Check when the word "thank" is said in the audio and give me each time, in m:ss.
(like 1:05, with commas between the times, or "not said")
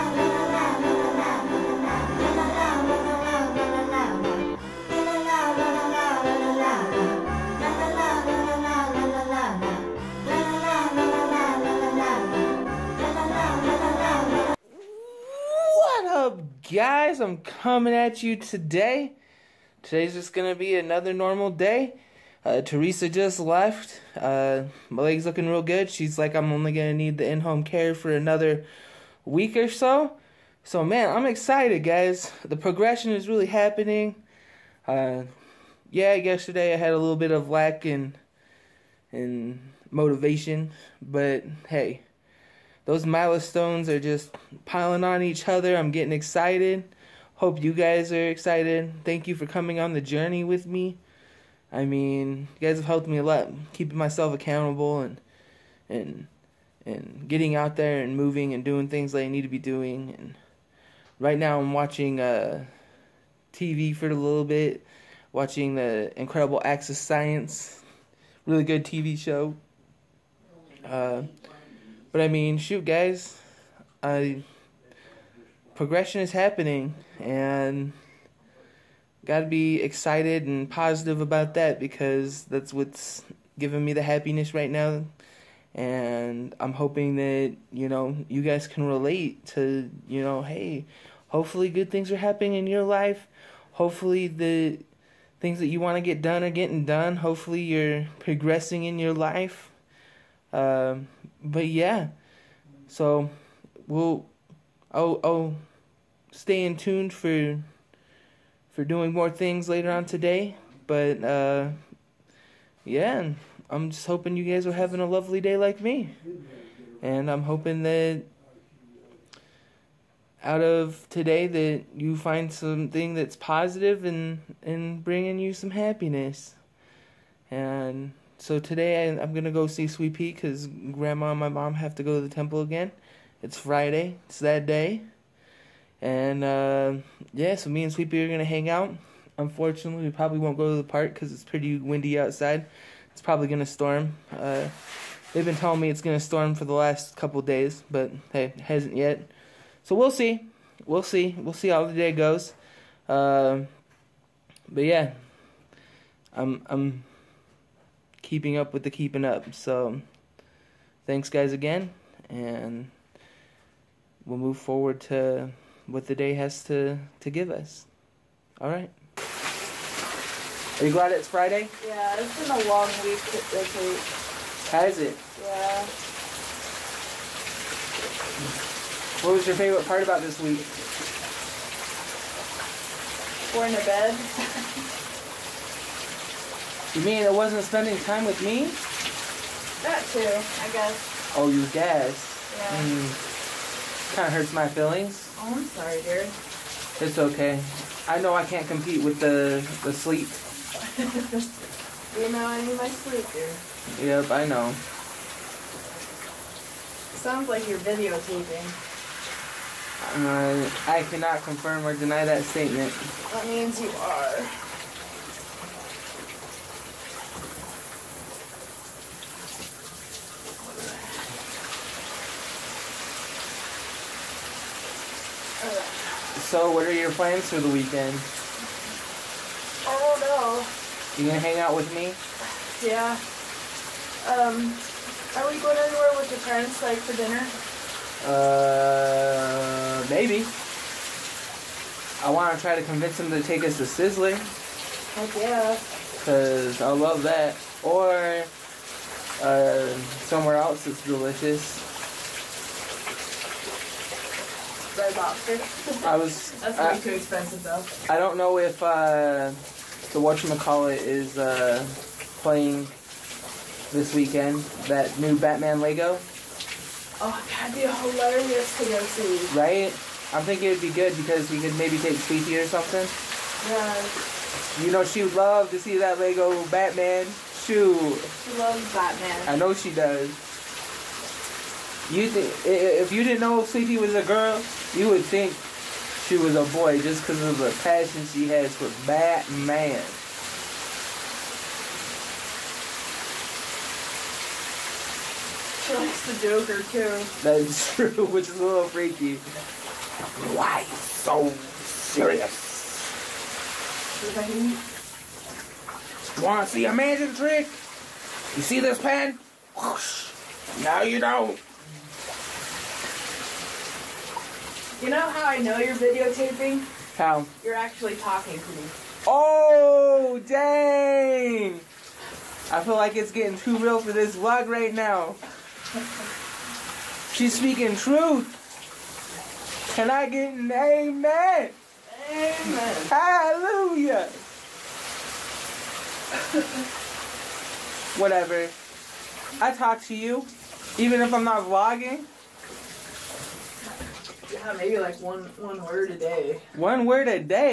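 0:49, 2:41.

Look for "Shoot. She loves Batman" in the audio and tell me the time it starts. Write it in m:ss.
4:37.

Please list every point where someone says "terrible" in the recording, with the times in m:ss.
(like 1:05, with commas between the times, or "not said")
not said.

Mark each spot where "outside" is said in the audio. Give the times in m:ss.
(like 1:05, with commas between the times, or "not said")
2:22.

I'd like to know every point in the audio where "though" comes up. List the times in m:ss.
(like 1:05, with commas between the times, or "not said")
4:17.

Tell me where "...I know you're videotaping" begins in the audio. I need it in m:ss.
5:15.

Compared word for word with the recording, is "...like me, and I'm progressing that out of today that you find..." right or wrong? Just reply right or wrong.
wrong.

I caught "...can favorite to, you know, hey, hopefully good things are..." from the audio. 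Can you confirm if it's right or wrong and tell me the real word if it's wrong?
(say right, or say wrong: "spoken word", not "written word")
wrong: "relate", not "favorite".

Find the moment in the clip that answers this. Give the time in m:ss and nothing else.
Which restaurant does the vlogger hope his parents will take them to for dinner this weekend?
4:03.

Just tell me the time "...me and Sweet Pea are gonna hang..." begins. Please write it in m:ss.
2:17.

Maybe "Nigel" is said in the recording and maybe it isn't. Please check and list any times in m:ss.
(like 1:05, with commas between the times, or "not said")
not said.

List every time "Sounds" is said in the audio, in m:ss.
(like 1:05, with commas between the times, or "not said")
3:27.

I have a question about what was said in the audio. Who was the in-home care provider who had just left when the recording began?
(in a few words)
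Teresa.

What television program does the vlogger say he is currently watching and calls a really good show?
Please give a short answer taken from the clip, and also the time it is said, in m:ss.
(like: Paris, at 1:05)
Incredible Acts of Science, at 1:06.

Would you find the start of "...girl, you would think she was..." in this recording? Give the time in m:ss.
4:44.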